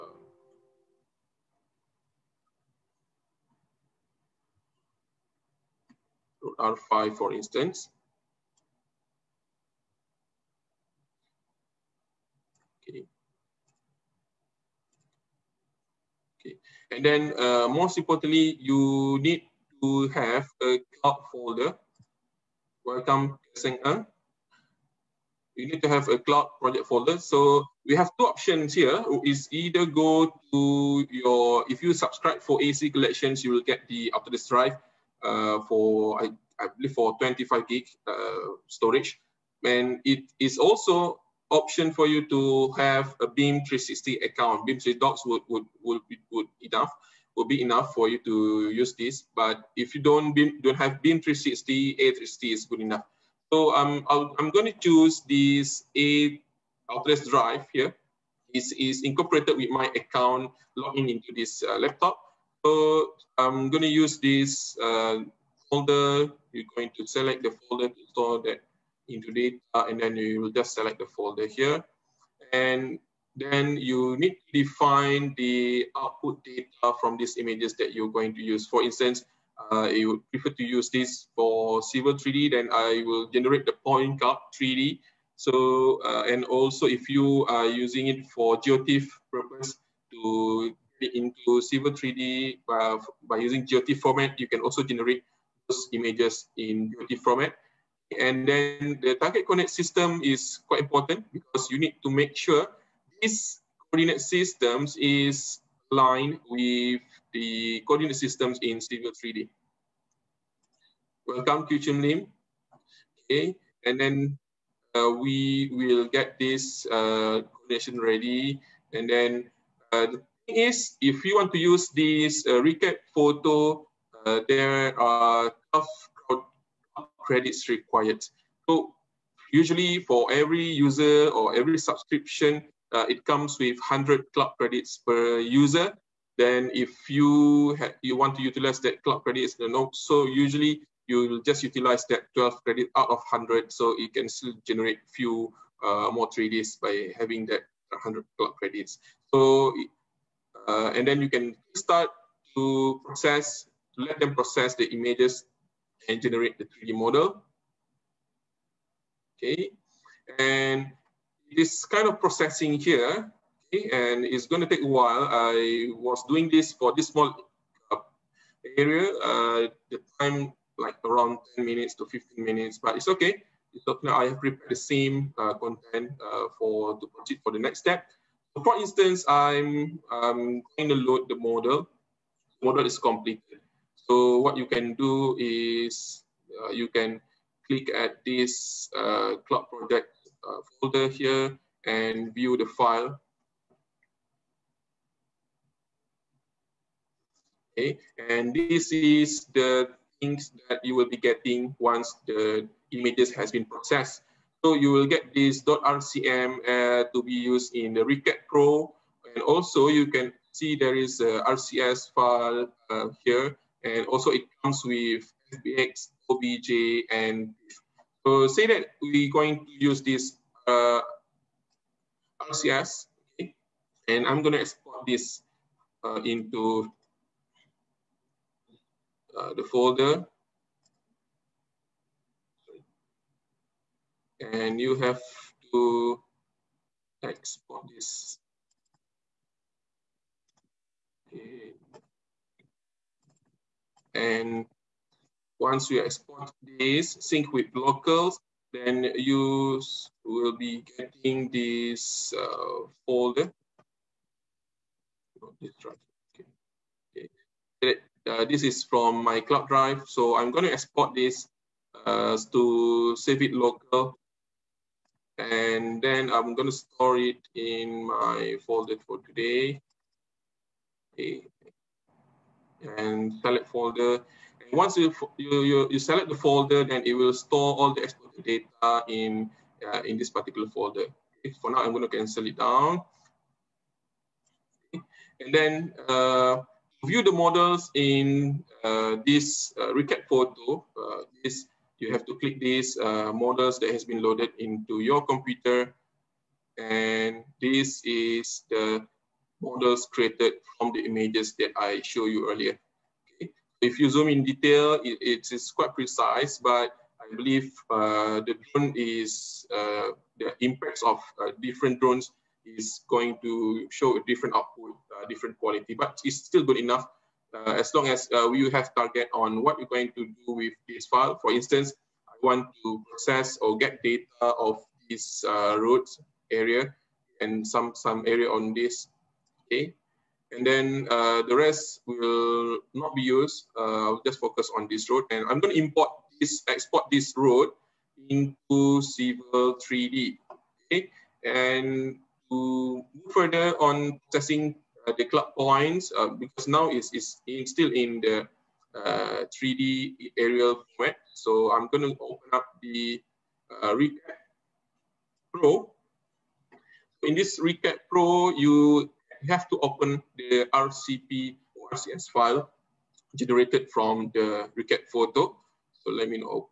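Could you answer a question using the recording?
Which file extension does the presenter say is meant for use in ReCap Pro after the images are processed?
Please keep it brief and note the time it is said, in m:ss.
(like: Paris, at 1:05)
.rcm, at 3:25.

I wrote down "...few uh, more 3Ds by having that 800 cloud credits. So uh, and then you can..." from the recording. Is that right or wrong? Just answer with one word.
wrong.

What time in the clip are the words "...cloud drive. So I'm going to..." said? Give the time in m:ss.
4:19.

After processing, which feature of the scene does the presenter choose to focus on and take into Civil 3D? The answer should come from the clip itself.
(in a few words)
road area.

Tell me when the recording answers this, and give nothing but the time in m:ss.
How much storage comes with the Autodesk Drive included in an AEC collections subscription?
0:37.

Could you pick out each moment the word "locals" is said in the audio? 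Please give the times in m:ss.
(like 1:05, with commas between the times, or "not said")
4:07, 4:23.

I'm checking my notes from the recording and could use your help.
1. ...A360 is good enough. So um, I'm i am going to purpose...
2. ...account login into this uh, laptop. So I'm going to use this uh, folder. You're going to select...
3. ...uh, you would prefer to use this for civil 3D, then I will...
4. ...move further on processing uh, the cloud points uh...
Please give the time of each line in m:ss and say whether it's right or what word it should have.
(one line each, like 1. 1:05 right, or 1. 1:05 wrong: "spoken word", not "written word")
1. 0:51 wrong: "choose", not "purpose"
2. 0:59 right
3. 1:19 right
4. 5:43 right.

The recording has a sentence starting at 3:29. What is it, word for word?
And also you can see there is a RCS file uh, here.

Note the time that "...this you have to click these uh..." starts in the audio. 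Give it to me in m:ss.
4:51.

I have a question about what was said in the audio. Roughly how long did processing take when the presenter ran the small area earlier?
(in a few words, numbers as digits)
10 to 15 minutes.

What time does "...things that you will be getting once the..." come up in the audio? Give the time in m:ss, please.
3:20.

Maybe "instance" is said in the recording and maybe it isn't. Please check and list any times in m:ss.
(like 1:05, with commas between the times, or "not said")
0:07, 1:18, 2:58, 5:21.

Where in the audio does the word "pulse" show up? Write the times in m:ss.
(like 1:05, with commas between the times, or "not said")
not said.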